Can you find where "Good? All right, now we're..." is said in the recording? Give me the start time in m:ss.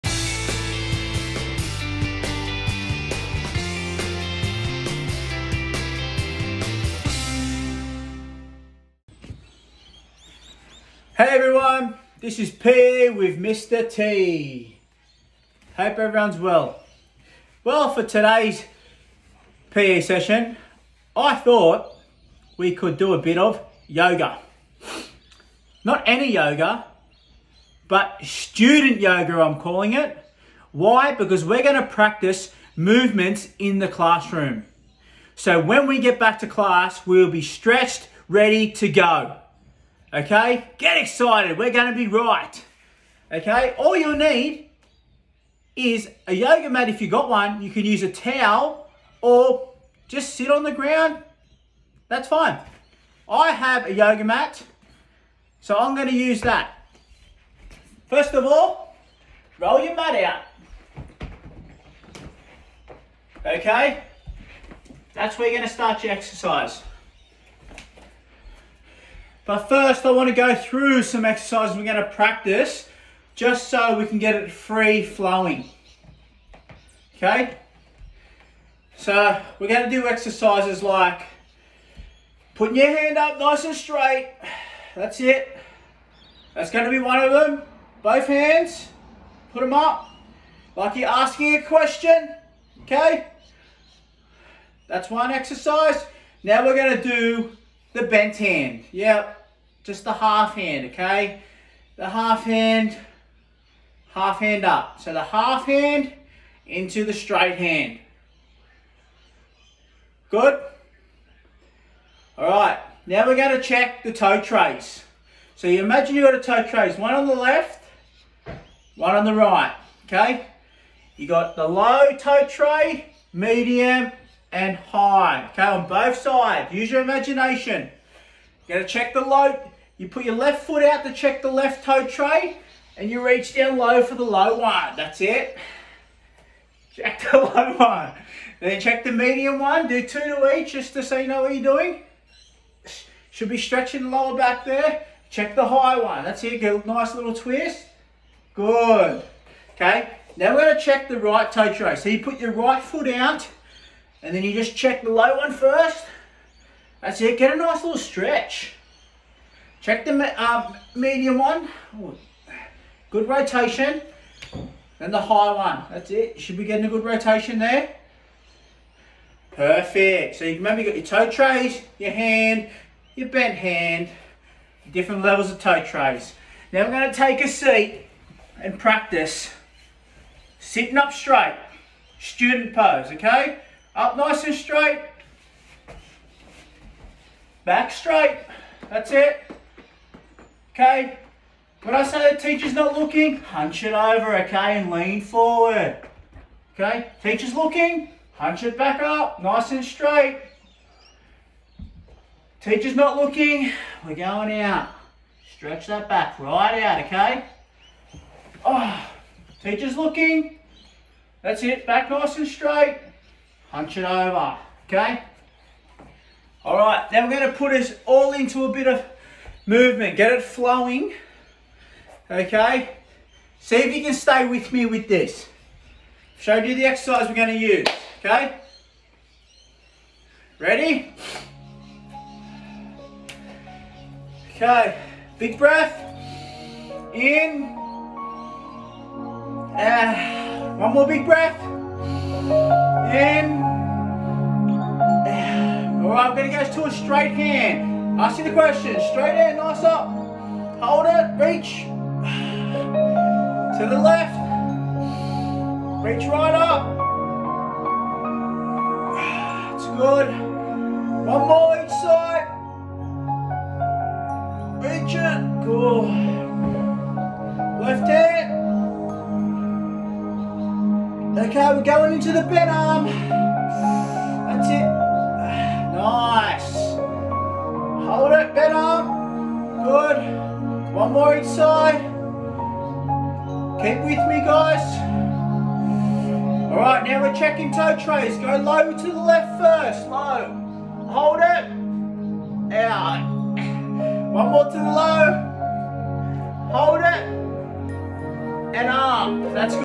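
1:50.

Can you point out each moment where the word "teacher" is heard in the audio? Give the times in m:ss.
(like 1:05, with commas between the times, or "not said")
3:12, 3:17, 3:22, 3:29.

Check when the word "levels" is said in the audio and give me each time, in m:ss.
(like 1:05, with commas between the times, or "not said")
2:55.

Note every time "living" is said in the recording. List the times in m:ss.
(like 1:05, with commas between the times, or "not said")
not said.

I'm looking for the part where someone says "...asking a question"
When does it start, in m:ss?
1:31.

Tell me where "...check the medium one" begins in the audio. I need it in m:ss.
2:18.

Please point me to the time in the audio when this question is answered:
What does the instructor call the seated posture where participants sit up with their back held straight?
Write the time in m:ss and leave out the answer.
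3:02.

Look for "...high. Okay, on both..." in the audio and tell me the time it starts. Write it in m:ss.
2:04.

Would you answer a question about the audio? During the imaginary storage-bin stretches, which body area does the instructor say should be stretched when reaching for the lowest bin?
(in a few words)
lower back.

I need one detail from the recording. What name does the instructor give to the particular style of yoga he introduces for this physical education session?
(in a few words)
student yoga.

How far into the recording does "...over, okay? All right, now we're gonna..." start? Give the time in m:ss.
3:34.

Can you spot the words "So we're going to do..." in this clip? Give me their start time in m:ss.
1:18.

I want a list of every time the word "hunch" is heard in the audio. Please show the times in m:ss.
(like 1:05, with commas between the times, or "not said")
3:13, 3:18, 3:33.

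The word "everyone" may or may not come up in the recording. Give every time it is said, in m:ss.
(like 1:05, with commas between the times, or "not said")
0:11, 0:15.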